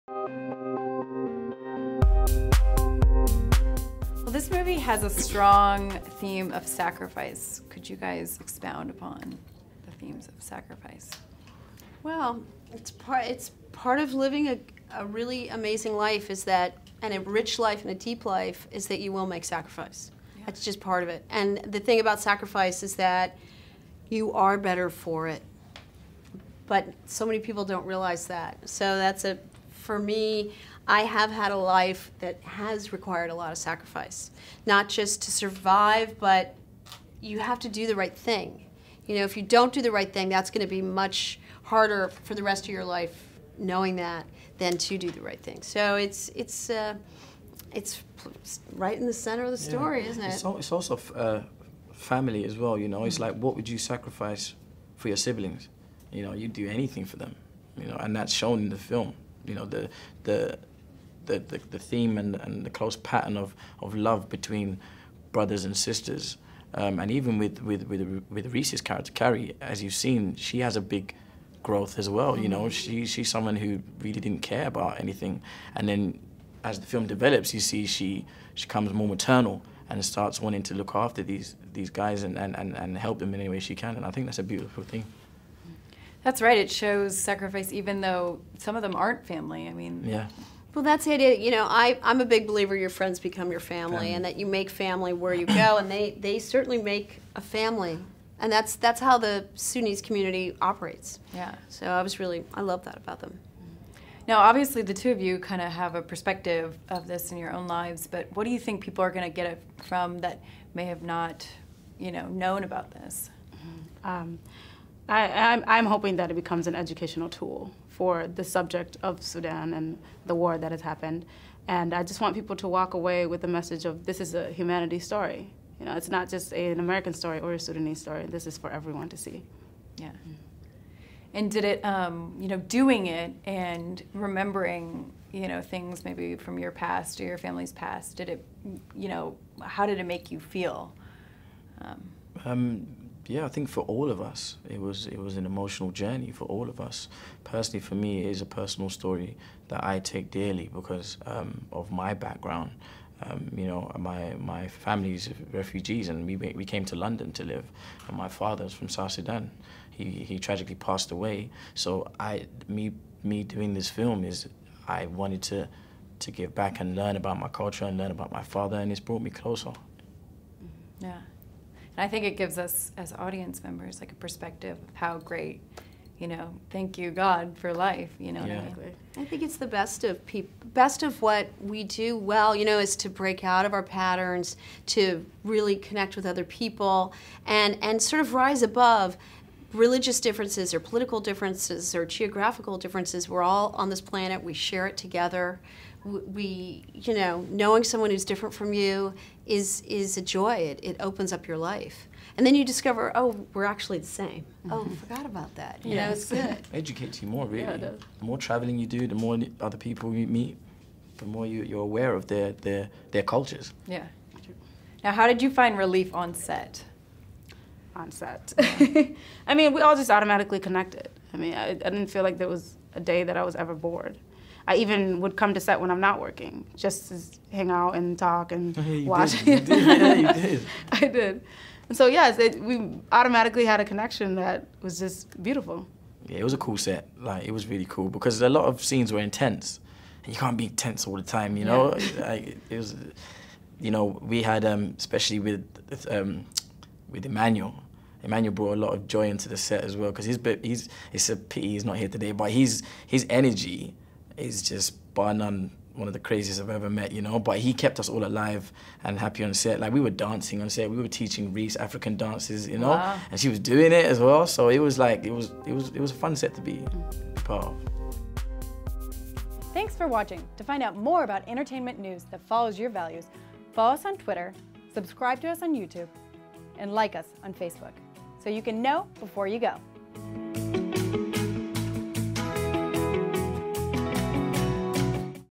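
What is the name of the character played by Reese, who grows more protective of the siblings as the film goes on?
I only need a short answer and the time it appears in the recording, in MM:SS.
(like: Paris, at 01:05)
Carrie, at 01:09.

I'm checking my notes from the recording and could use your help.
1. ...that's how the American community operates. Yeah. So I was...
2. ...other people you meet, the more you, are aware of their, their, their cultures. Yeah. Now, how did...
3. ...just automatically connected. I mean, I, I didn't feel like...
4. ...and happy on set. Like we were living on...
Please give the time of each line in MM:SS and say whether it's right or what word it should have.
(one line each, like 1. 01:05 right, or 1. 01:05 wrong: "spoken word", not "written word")
1. 01:38 wrong: "Sudanese", not "American"
2. 03:29 right
3. 03:39 right
4. 04:19 wrong: "dancing", not "living".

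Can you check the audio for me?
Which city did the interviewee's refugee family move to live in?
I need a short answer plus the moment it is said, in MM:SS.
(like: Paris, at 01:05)
London, at 02:36.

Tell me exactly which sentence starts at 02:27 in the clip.
Personally, for me, it is a personal story that I take dearly because um, of my background.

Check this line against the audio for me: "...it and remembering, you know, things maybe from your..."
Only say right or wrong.
right.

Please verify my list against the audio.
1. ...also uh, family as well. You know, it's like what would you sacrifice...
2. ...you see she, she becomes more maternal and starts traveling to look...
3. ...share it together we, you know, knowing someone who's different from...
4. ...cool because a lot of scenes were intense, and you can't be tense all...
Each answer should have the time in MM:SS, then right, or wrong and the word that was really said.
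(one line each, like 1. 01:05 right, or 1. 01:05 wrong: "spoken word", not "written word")
1. 00:50 right
2. 01:17 wrong: "wanting", not "traveling"
3. 03:14 right
4. 03:57 right.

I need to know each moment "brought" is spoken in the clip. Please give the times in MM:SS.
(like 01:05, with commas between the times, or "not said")
02:48, 04:08.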